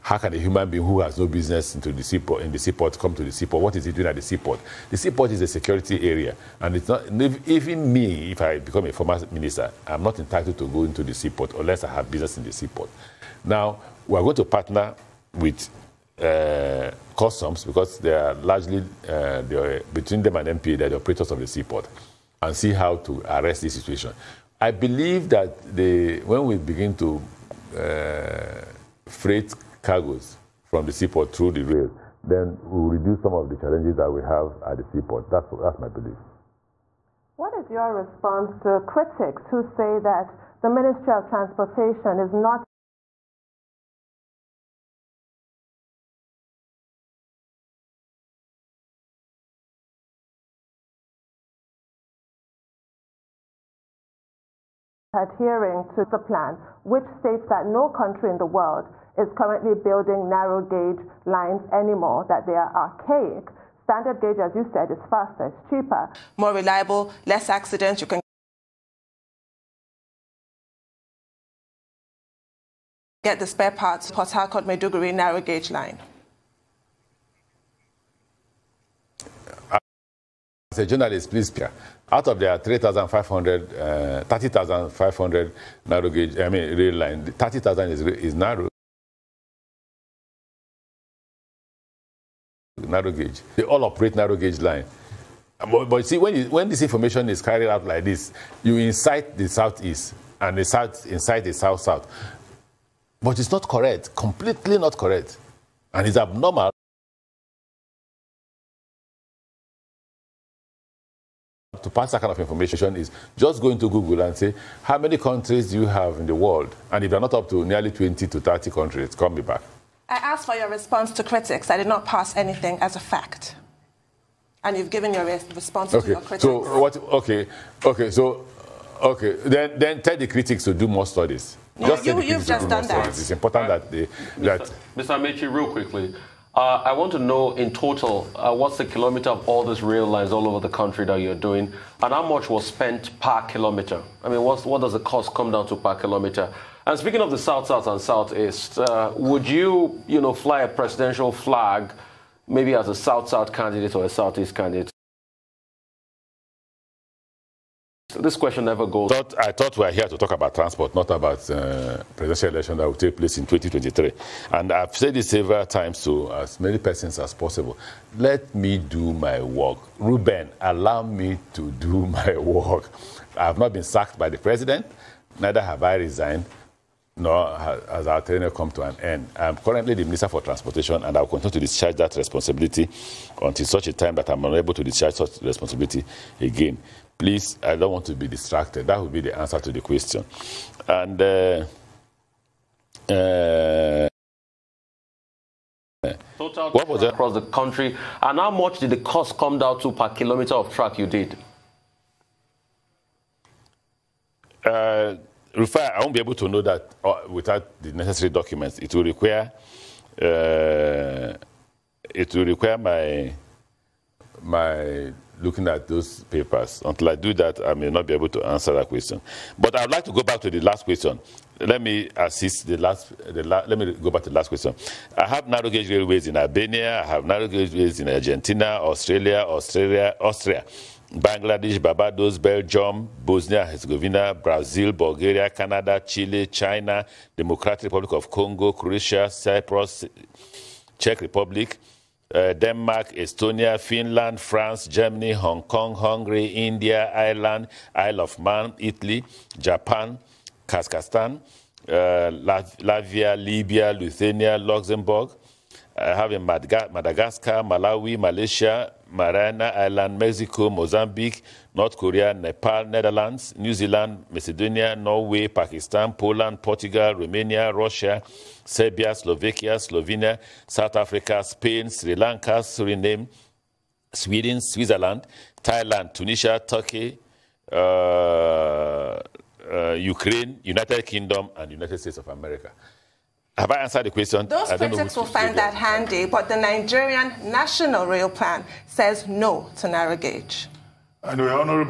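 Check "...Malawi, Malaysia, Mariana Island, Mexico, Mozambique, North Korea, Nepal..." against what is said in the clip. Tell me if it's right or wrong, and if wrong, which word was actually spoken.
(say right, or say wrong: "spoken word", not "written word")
right.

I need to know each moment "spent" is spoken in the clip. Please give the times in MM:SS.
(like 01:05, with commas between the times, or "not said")
02:22.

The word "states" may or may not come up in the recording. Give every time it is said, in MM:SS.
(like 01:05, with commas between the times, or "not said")
00:57, 04:41.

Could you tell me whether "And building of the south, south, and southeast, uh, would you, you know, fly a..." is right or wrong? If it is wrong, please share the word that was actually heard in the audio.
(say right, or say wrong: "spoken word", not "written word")
wrong: "speaking", not "building".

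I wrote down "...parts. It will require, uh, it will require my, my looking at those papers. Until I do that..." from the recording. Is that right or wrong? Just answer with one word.
wrong.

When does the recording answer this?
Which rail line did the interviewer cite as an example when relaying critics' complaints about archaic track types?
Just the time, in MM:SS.
01:14.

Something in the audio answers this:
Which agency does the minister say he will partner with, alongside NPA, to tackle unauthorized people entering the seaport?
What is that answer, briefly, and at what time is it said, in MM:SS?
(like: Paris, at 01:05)
Customs, at 00:17.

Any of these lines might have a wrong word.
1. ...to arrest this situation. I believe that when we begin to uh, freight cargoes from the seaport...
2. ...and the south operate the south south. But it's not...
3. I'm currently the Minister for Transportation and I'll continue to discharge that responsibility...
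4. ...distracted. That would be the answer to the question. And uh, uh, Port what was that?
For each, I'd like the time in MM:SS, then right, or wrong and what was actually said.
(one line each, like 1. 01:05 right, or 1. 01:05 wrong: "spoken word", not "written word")
1. 00:22 right
2. 01:40 wrong: "incite", not "operate"
3. 02:59 right
4. 03:08 wrong: "Total", not "Port".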